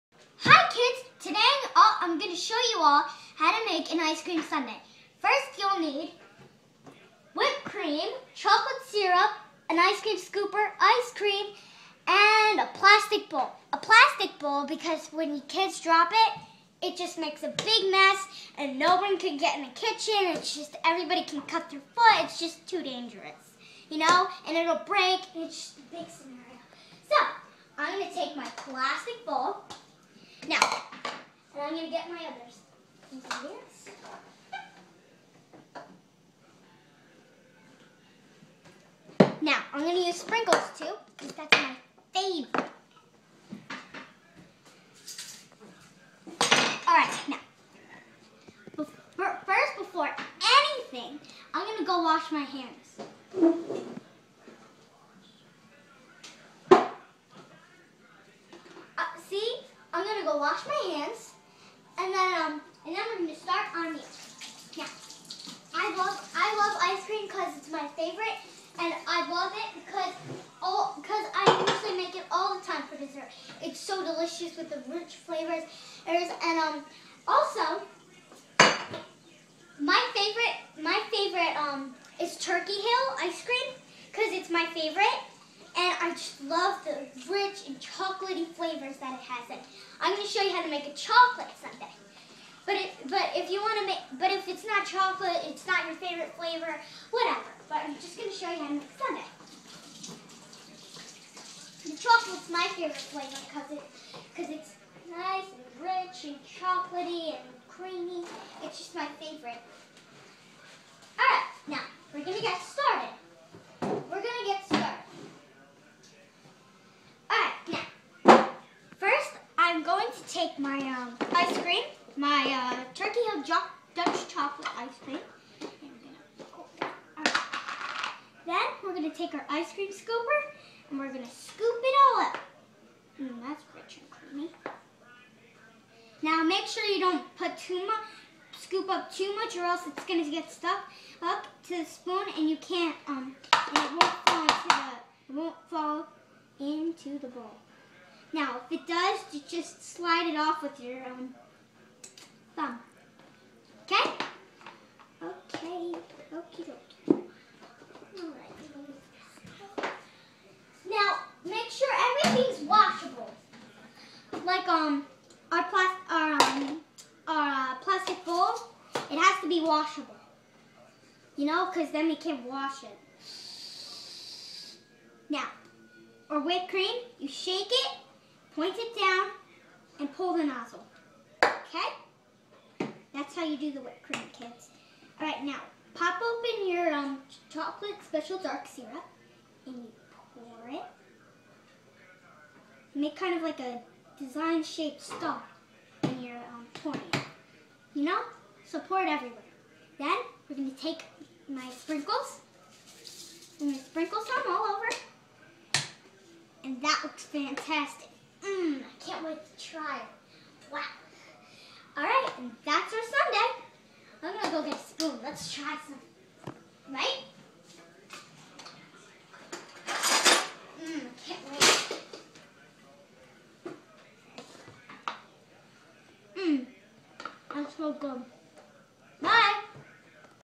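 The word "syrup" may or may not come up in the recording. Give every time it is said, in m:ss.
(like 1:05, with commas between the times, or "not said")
0:08, 3:08.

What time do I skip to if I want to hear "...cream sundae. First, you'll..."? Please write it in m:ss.
0:04.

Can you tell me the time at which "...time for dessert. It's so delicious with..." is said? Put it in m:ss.
1:12.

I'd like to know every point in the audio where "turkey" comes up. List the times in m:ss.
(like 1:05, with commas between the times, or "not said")
1:22, 2:02.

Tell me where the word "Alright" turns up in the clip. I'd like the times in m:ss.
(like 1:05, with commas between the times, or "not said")
0:46, 2:37, 3:31.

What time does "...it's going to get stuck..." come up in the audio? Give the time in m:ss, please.
2:19.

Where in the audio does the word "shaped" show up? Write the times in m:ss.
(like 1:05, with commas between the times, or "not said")
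3:14.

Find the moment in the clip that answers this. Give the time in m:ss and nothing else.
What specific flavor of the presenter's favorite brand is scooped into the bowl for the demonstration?
2:03.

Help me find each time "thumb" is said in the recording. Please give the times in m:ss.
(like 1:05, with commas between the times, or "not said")
2:32.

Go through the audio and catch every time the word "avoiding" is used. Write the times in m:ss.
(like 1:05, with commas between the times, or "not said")
not said.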